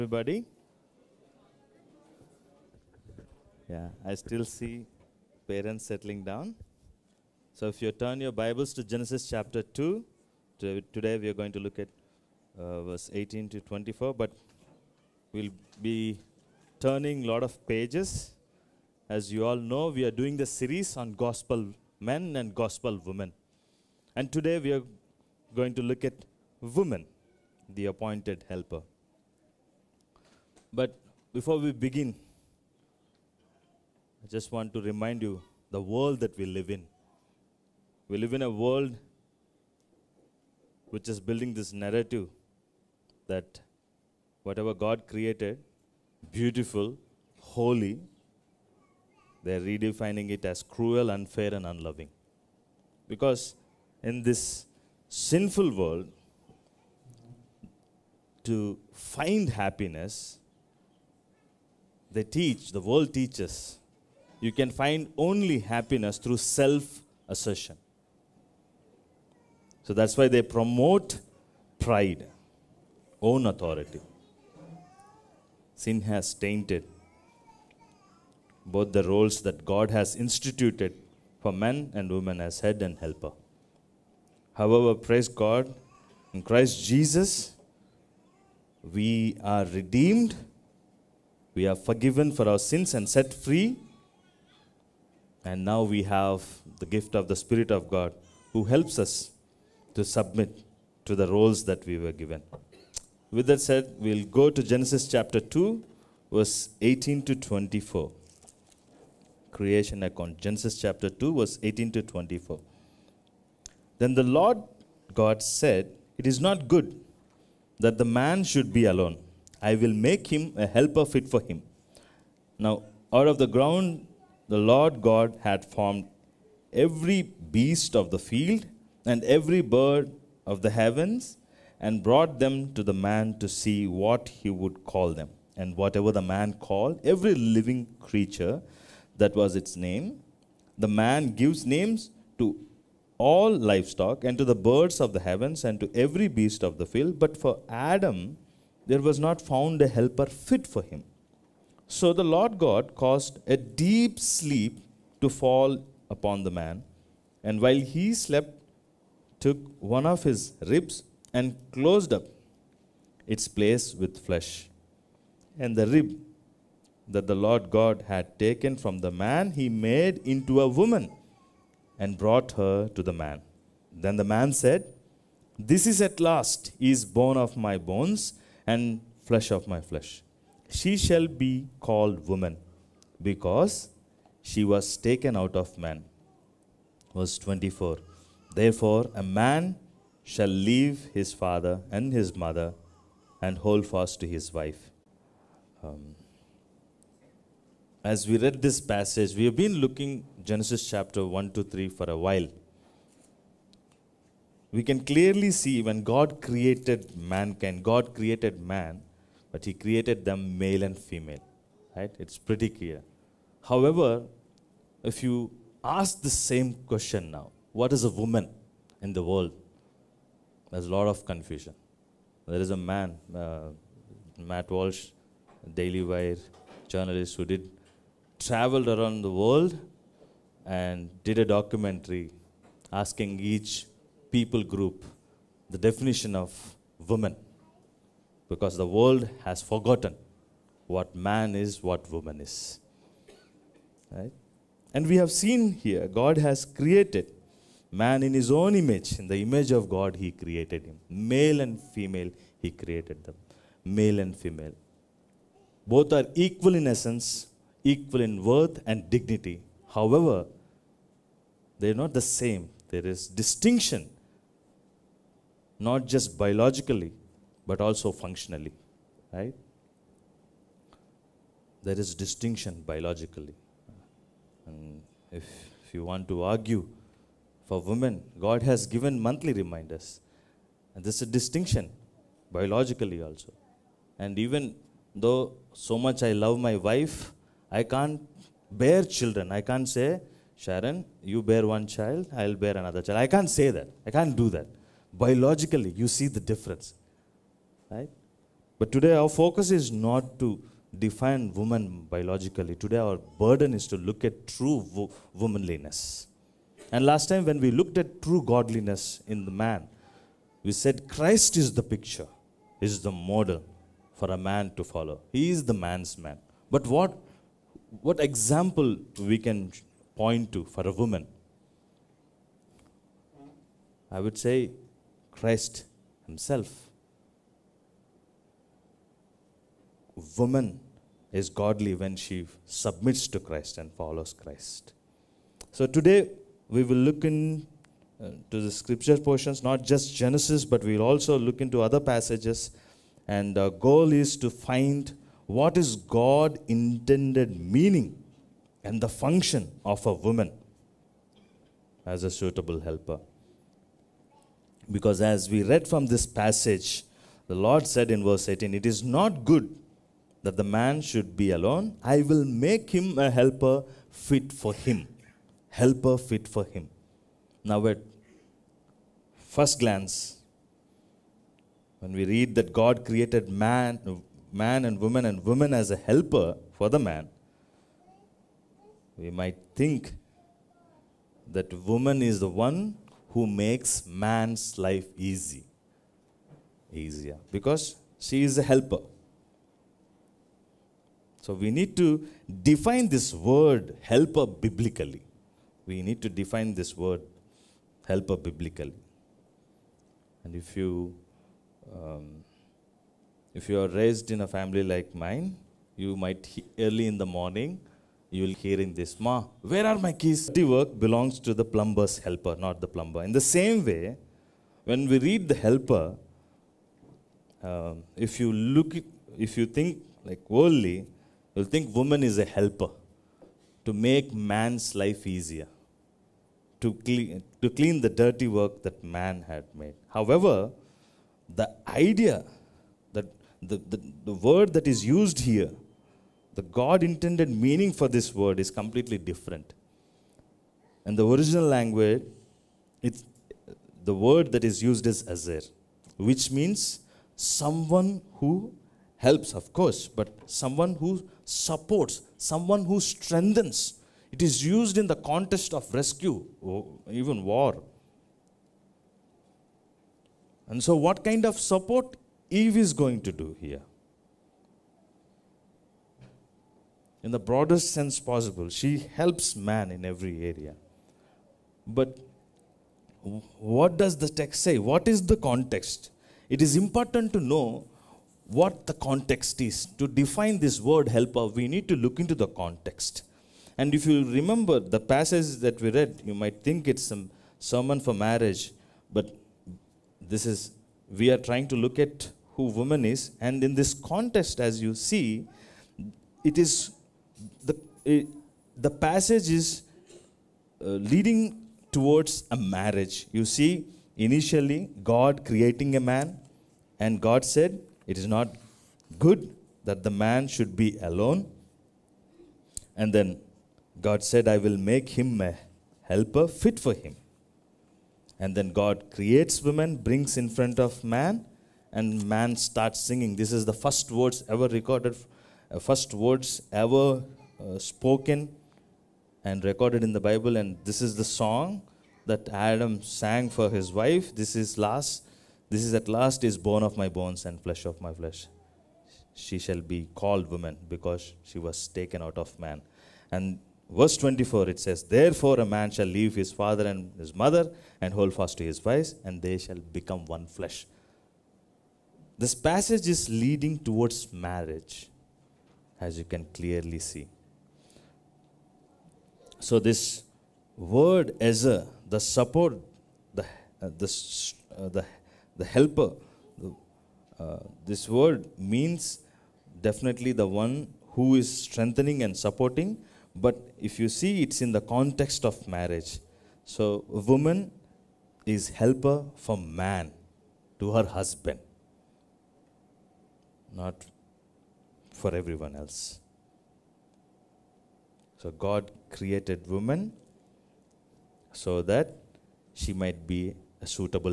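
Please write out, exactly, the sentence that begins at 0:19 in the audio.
As you all know, we are doing the series on gospel men and gospel women.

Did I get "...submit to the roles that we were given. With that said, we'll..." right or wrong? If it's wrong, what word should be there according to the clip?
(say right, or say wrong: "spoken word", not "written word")
right.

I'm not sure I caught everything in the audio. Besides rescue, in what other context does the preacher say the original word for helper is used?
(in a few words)
war.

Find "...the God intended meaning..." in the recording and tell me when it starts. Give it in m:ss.
7:16.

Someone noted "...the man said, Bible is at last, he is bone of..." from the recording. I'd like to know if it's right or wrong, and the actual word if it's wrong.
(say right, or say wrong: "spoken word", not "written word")
wrong: "This", not "Bible".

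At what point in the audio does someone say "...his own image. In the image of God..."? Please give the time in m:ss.
4:08.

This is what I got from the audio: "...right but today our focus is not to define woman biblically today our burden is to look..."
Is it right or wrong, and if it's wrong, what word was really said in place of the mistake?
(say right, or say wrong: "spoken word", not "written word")
wrong: "biologically", not "biblically".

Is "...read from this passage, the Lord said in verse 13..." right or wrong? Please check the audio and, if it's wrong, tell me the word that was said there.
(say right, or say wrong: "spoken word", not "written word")
wrong: "18", not "13".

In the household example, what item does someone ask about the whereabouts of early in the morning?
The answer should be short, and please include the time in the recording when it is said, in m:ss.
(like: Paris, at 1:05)
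keys, at 6:50.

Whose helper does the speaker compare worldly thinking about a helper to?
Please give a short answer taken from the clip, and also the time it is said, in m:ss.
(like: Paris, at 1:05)
the plumber's helper, at 6:51.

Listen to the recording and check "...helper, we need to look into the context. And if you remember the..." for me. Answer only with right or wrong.
right.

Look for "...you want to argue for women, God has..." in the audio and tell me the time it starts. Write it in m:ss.
4:35.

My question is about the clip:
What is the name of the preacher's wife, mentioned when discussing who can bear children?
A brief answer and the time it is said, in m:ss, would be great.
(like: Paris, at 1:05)
Sharon, at 4:50.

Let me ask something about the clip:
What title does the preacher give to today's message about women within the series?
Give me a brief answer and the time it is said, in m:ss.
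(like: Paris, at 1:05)
the appointed helper, at 0:27.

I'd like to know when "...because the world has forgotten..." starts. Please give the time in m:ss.
3:58.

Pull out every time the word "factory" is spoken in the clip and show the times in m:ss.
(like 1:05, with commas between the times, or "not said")
not said.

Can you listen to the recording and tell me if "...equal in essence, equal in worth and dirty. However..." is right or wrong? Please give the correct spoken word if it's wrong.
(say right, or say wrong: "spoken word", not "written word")
wrong: "dignity", not "dirty".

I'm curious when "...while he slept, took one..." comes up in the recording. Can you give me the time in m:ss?
2:37.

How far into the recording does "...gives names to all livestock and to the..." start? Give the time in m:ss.
2:21.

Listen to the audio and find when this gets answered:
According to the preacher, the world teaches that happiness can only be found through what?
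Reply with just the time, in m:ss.
1:06.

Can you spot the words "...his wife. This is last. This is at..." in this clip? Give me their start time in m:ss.
8:53.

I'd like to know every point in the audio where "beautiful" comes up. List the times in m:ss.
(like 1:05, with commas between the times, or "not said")
0:46.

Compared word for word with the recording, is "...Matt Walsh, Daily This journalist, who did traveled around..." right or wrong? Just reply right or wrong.
wrong.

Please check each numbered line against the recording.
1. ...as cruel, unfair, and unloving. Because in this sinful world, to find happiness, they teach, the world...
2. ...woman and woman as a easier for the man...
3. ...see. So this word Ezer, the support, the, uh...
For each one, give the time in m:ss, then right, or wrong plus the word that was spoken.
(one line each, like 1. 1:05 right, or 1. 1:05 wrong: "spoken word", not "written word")
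1. 0:50 right
2. 6:14 wrong: "helper", not "easier"
3. 9:16 right.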